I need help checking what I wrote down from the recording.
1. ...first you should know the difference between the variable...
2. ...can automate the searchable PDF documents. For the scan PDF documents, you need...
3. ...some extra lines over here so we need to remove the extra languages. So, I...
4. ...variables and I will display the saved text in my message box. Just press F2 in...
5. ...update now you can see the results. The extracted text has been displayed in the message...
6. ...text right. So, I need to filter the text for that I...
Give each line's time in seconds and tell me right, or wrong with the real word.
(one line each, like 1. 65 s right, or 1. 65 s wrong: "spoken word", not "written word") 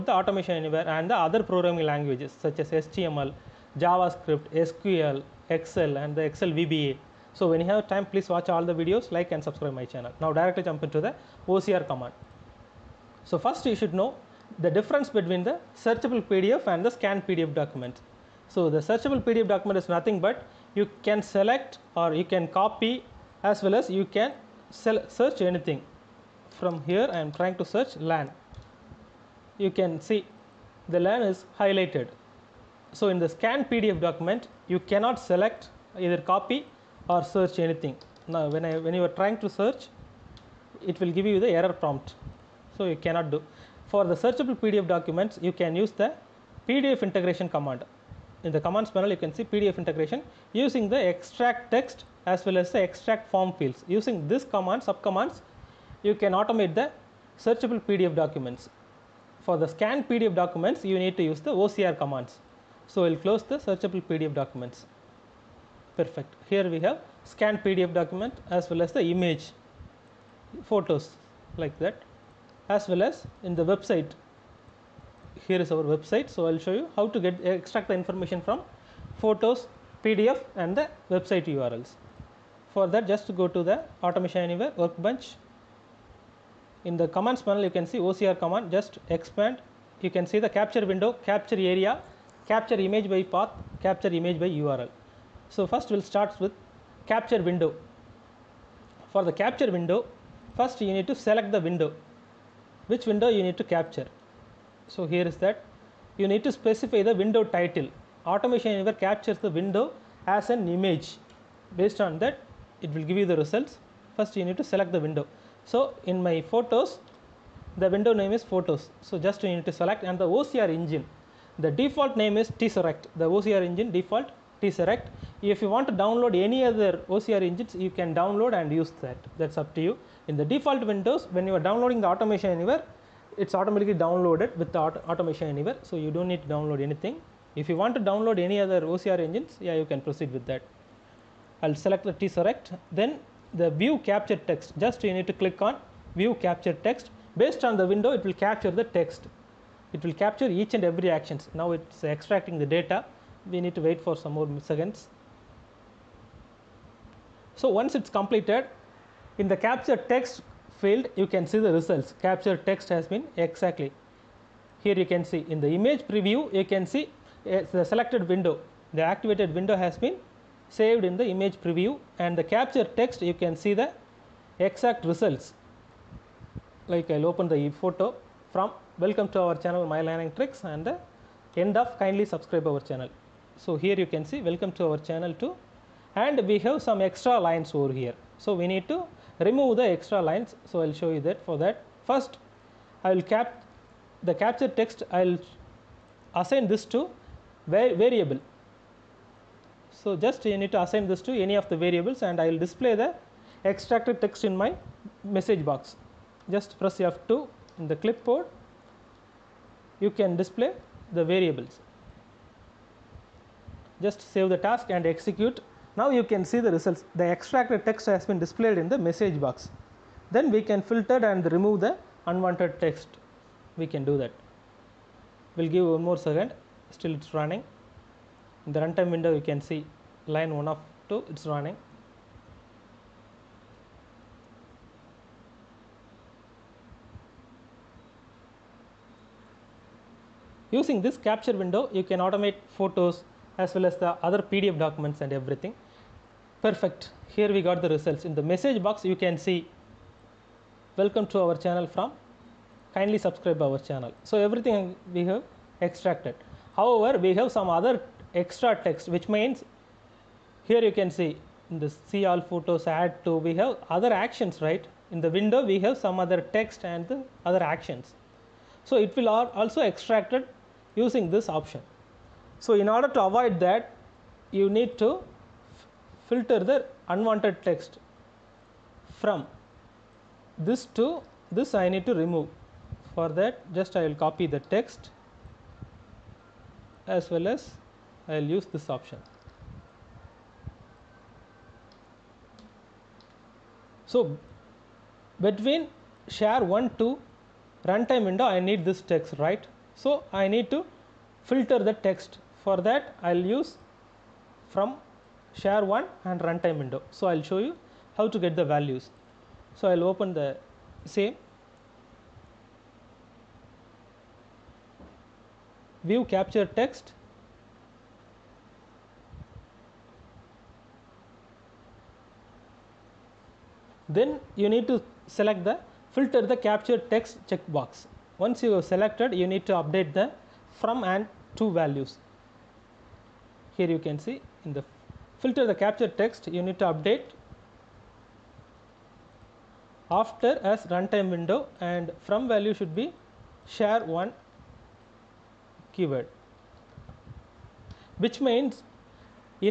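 1. 13 s wrong: "searchable", not "variable"
2. 56 s right
3. 186 s wrong: "lines", not "languages"
4. 201 s wrong: "extracted", not "saved"
5. 215 s wrong: "execute", not "update"
6. 299 s right.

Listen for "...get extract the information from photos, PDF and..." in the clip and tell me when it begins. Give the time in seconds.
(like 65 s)
77 s.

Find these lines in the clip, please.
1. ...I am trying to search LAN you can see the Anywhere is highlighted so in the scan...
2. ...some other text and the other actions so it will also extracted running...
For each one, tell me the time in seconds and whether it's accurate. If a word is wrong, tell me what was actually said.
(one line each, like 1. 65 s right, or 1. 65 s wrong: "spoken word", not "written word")
1. 27 s wrong: "LAN", not "Anywhere"
2. 266 s wrong: "using", not "running".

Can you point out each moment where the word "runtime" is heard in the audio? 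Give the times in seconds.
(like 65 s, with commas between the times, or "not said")
228 s, 297 s, 306 s, 340 s.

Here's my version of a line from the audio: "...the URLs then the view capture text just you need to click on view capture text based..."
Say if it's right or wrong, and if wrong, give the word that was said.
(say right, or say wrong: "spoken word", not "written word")
wrong: "Tesseract", not "URLs".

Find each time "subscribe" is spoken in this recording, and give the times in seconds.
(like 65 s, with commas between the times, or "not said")
9 s, 182 s, 253 s.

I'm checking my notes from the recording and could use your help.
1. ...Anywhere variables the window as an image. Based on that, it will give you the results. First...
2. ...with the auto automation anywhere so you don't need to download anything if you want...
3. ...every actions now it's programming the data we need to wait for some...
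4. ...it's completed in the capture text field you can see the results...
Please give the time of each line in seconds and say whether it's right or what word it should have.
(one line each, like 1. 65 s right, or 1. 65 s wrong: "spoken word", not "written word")
1. 108 s wrong: "captures", not "variables"
2. 134 s right
3. 150 s wrong: "extracting", not "programming"
4. 157 s right.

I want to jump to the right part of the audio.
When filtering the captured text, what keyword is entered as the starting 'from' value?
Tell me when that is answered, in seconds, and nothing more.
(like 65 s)
342 s.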